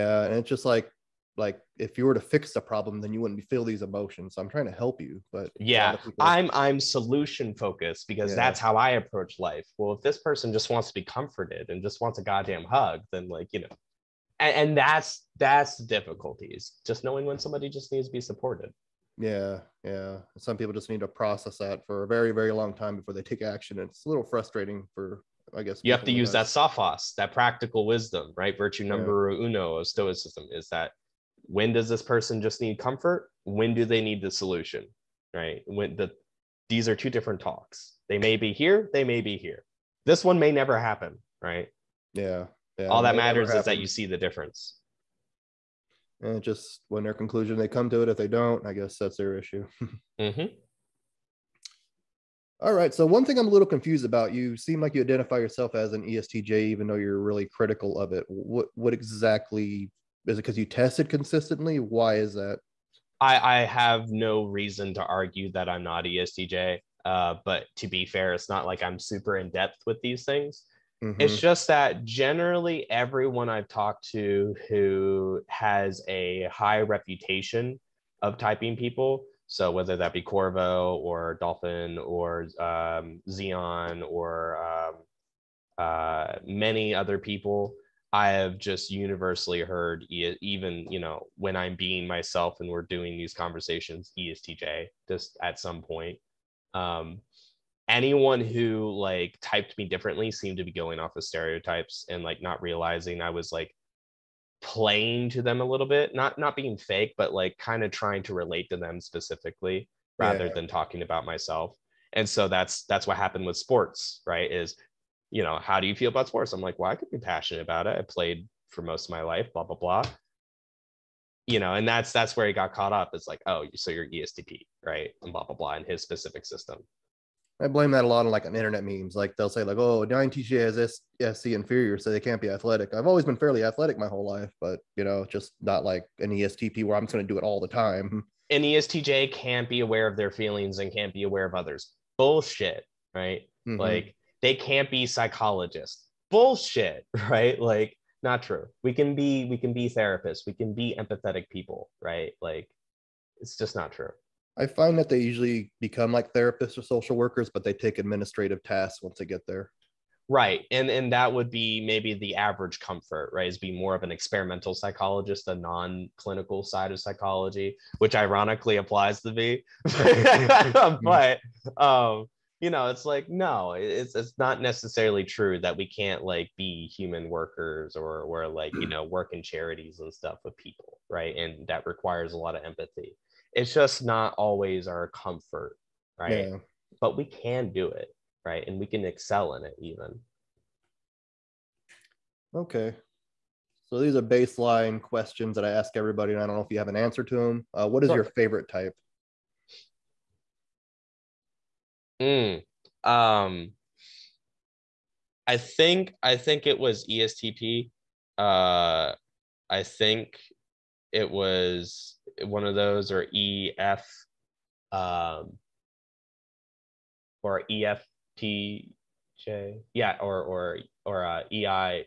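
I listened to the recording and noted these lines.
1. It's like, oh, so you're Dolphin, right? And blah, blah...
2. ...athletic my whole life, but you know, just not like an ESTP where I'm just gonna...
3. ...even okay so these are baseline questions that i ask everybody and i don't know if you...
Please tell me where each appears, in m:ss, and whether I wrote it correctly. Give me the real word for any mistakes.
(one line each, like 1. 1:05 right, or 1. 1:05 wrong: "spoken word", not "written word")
1. 2:03 wrong: "ESTP", not "Dolphin"
2. 2:13 right
3. 3:09 right.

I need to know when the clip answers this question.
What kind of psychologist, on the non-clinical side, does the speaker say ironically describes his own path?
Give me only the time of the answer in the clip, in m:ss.
2:44.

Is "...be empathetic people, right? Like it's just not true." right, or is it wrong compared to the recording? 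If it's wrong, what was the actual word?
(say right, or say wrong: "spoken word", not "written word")
right.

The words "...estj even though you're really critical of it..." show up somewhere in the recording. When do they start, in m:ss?
0:56.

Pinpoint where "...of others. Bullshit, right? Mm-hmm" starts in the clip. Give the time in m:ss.
2:21.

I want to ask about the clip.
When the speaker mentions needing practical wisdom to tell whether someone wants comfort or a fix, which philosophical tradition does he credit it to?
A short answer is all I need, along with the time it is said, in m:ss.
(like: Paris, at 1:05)
Stoicism, at 0:29.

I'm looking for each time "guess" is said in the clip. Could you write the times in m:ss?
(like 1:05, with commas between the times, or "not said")
0:25, 0:48.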